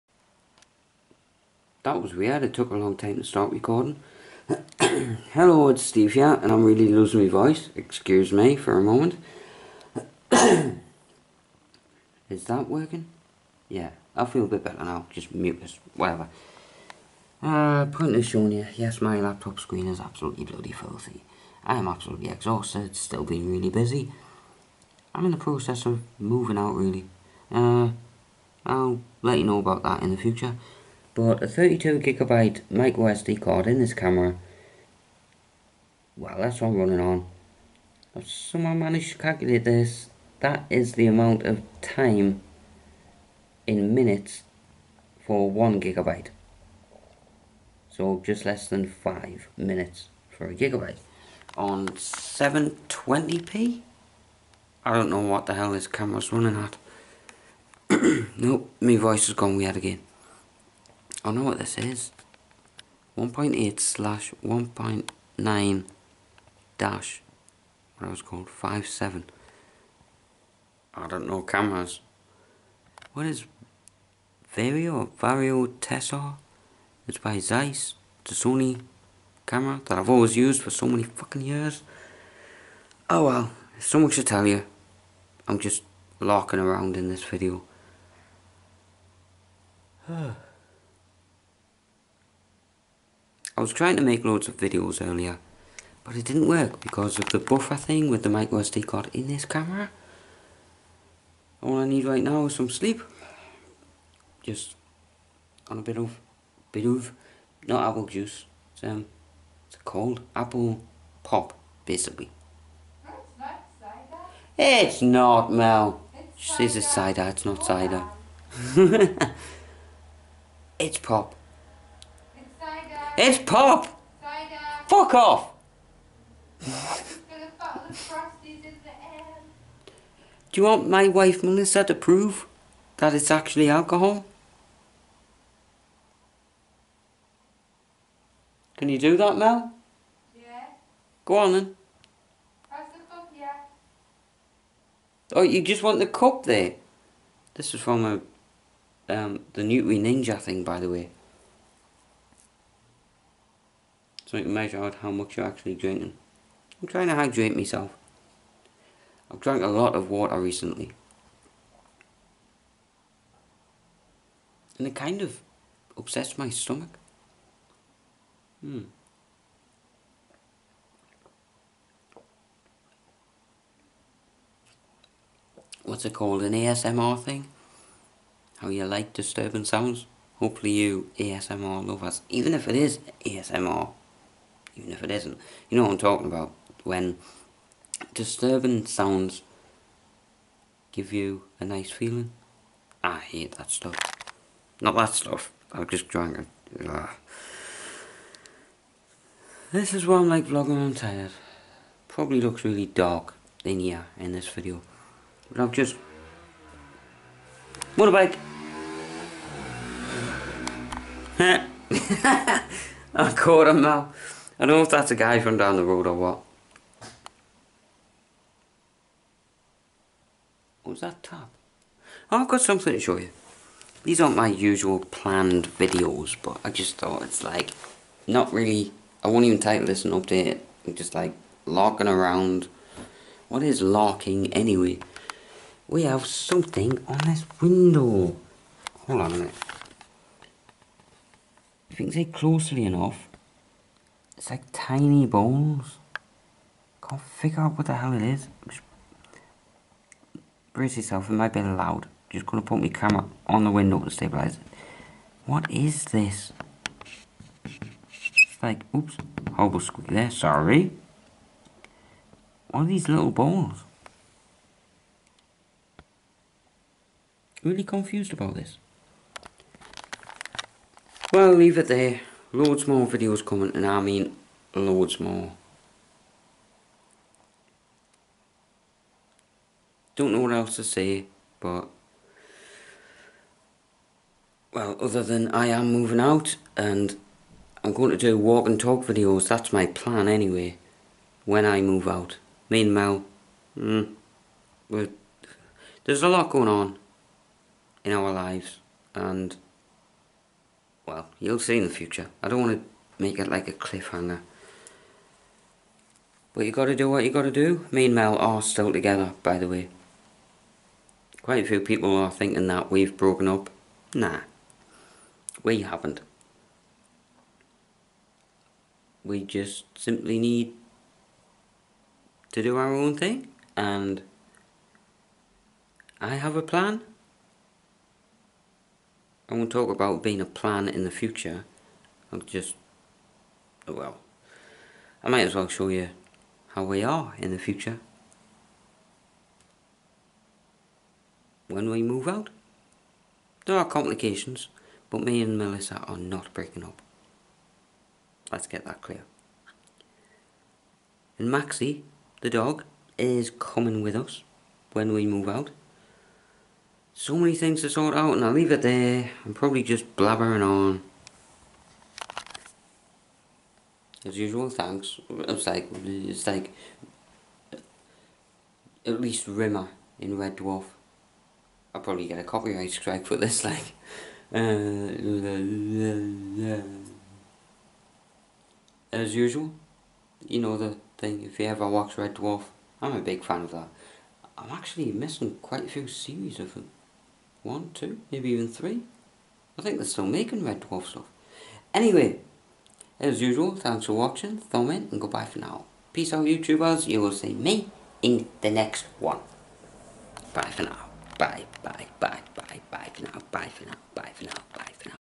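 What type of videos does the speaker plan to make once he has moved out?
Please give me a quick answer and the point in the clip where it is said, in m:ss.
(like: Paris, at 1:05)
walk and talk videos, at 4:48.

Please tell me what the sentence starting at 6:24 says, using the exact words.
I'm actually missing quite a few series of them.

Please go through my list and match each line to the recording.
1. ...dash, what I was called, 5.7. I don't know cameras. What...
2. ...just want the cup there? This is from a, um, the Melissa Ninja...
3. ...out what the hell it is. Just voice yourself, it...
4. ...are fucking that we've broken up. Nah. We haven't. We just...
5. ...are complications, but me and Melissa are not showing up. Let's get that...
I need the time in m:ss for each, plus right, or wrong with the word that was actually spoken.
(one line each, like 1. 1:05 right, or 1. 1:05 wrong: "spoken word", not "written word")
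1. 1:06 right
2. 2:25 wrong: "Nutri", not "Melissa"
3. 4:07 wrong: "brace", not "voice"
4. 5:12 wrong: "thinking", not "fucking"
5. 5:43 wrong: "breaking", not "showing".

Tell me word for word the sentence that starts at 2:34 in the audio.
so I can measure out how much you're actually drinking.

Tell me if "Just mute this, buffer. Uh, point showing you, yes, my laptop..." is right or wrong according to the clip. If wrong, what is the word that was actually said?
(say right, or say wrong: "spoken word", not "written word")
wrong: "whatever", not "buffer".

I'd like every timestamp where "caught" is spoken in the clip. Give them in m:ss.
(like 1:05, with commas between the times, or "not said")
3:33.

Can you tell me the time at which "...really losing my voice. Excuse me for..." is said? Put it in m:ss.
0:06.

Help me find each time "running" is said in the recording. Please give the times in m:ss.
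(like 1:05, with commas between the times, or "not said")
0:36, 0:56.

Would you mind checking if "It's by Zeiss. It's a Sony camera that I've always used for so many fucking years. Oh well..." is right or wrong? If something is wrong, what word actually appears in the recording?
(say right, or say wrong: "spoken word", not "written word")
right.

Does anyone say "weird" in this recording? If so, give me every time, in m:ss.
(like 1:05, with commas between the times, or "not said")
0:02, 0:59.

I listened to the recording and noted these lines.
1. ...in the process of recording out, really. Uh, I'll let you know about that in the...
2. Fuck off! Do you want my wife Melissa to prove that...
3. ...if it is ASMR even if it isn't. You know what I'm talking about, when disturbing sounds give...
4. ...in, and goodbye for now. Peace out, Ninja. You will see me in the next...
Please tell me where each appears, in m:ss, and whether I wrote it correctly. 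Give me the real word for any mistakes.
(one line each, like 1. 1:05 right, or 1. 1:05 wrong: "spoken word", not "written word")
1. 0:25 wrong: "moving", not "recording"
2. 2:04 right
3. 3:02 right
4. 6:34 wrong: "YouTubers", not "Ninja".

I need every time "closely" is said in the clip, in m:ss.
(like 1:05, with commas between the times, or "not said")
4:02.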